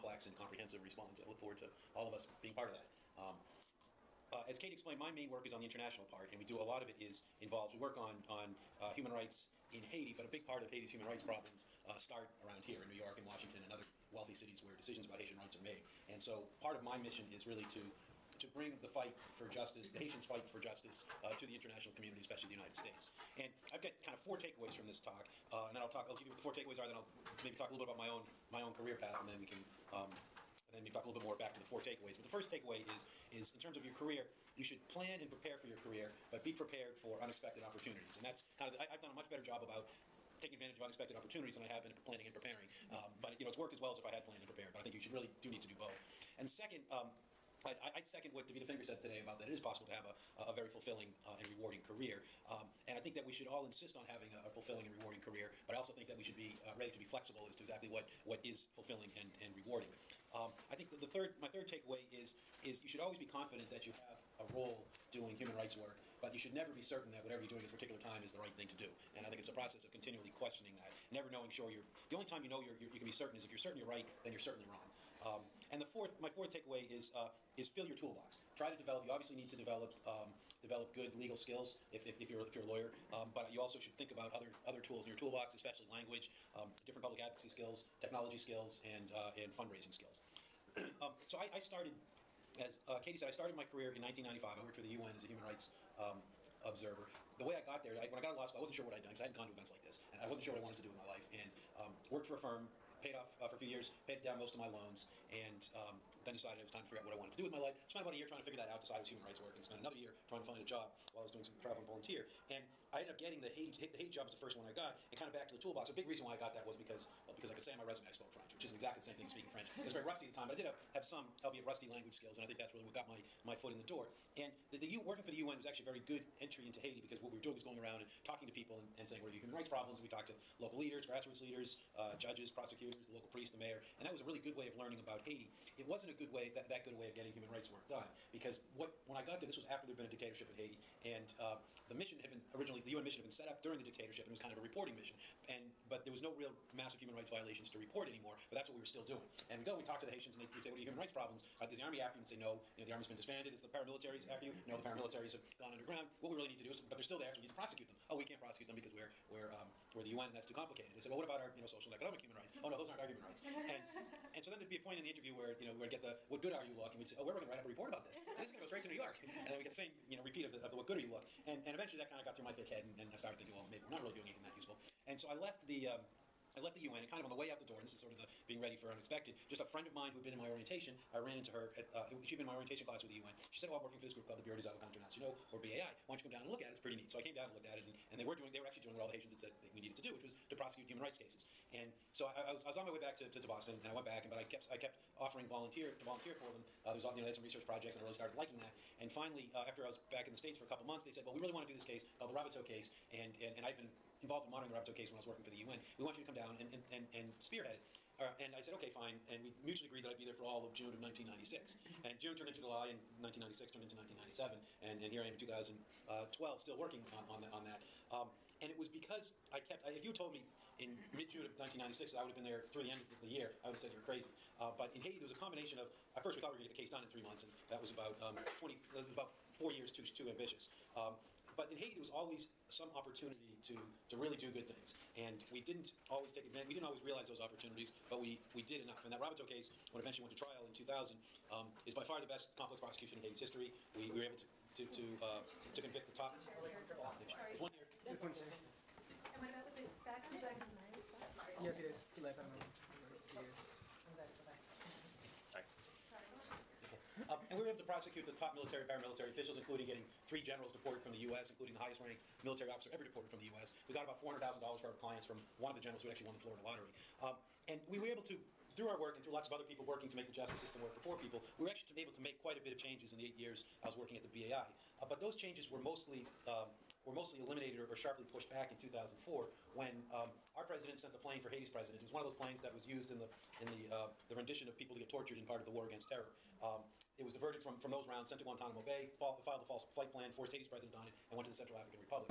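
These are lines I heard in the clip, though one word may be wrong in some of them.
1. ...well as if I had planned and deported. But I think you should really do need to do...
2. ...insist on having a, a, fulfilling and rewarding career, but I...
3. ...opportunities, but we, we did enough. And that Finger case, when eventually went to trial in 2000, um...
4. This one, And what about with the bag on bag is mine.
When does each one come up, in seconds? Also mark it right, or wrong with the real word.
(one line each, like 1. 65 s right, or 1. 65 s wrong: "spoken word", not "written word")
1. 43 s wrong: "prepared", not "deported"
2. 53 s right
3. 237 s wrong: "Raboteau", not "Finger"
4. 248 s right.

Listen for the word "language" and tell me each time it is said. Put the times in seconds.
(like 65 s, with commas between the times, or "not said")
85 s, 121 s.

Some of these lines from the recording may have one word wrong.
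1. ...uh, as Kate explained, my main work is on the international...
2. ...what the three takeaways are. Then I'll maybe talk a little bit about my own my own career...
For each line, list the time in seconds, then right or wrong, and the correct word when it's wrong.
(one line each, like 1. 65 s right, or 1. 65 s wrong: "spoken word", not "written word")
1. 4 s right
2. 26 s wrong: "four", not "three".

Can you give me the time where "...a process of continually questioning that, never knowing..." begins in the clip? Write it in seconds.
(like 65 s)
69 s.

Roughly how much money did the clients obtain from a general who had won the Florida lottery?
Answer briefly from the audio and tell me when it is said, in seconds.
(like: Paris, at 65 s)
$400,000, at 264 s.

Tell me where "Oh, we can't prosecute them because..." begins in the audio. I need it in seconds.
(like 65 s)
158 s.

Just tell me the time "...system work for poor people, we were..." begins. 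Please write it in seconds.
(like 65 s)
270 s.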